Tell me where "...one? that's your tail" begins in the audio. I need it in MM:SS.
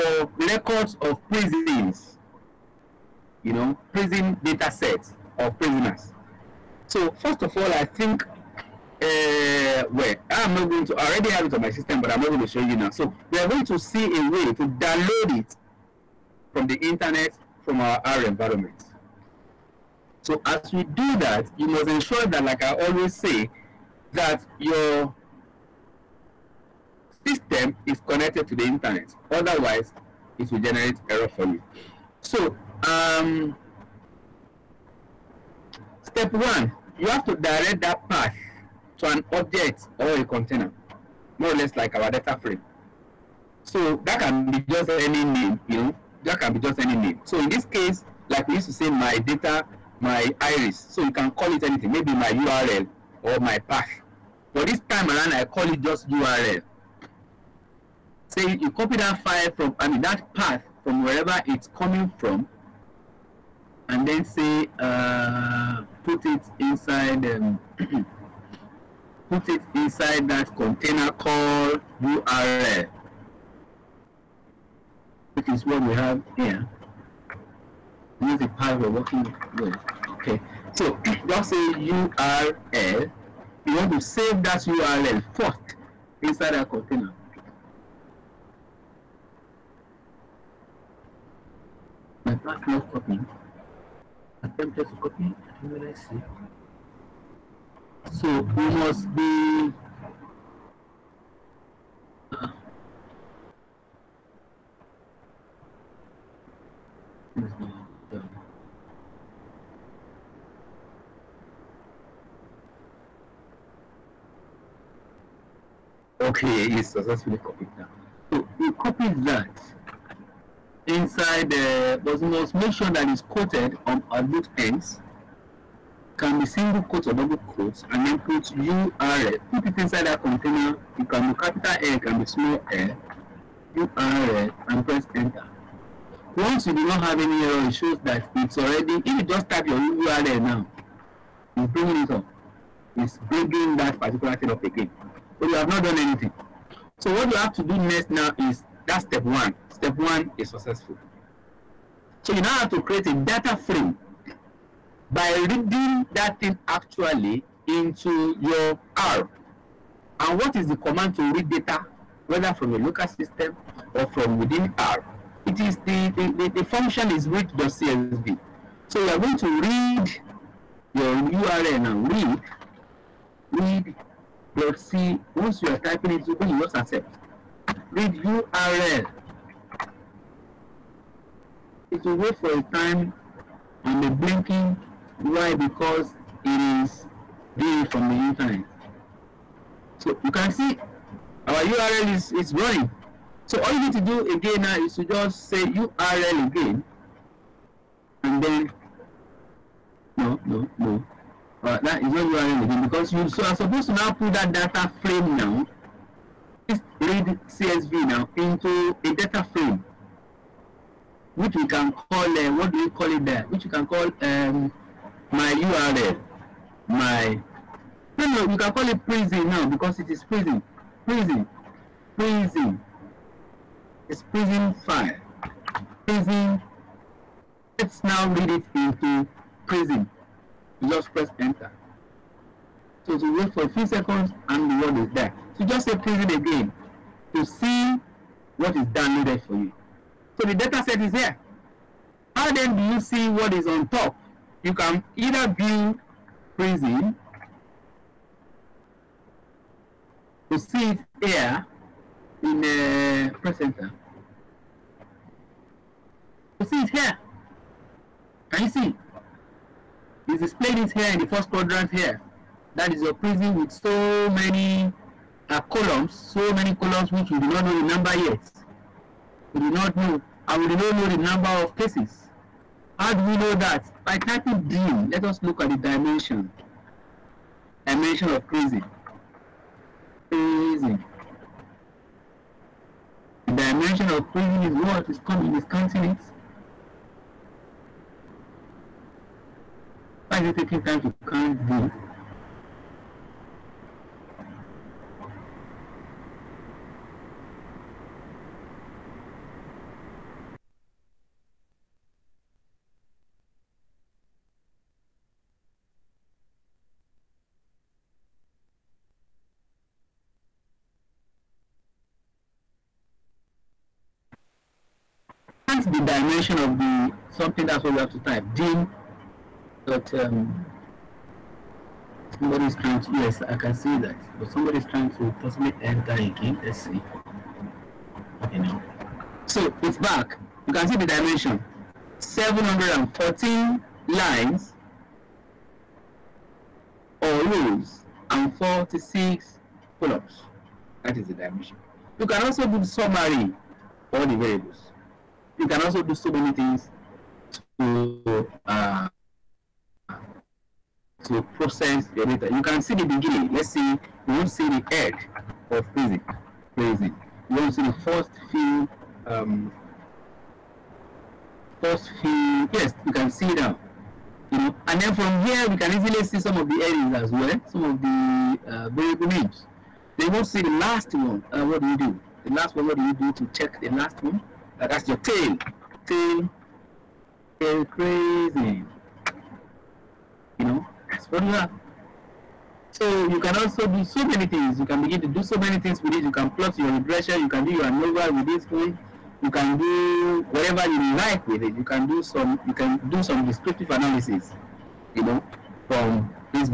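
06:14.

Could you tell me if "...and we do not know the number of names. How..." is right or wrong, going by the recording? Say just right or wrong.
wrong.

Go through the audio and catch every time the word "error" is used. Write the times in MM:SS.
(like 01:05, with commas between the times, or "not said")
00:31, 02:17.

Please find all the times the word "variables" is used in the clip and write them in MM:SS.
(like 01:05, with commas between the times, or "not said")
05:44, 06:08.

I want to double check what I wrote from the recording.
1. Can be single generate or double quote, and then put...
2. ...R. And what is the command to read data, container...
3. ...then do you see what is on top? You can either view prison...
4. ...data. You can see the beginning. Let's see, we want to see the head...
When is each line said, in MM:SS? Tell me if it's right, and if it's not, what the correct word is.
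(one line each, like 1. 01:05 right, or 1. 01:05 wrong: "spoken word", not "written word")
1. 02:06 wrong: "quote", not "generate"
2. 02:38 wrong: "whether", not "container"
3. 04:02 right
4. 05:52 right.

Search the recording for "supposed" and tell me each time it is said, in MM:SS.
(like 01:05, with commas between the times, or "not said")
03:23.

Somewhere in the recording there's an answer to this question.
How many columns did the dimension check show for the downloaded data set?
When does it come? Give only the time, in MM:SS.
05:38.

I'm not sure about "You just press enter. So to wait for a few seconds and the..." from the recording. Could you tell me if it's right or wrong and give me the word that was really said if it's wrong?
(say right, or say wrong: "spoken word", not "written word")
right.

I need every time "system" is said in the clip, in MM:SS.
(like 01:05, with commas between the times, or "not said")
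00:11, 00:27, 02:43.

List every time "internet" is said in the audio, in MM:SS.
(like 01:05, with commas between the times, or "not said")
00:16, 00:28, 03:08.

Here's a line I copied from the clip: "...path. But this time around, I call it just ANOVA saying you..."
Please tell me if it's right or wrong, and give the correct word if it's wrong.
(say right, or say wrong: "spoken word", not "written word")
wrong: "URL", not "ANOVA".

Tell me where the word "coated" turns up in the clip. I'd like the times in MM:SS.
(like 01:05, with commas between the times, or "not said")
02:03.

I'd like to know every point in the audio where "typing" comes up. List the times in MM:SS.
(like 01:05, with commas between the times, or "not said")
02:55, 04:34.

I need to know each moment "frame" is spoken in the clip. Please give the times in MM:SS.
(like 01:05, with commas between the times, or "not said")
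00:42, 02:33, 03:25, 03:29.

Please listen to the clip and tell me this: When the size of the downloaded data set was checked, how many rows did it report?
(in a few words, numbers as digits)
714.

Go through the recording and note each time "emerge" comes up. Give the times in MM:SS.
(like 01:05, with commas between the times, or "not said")
not said.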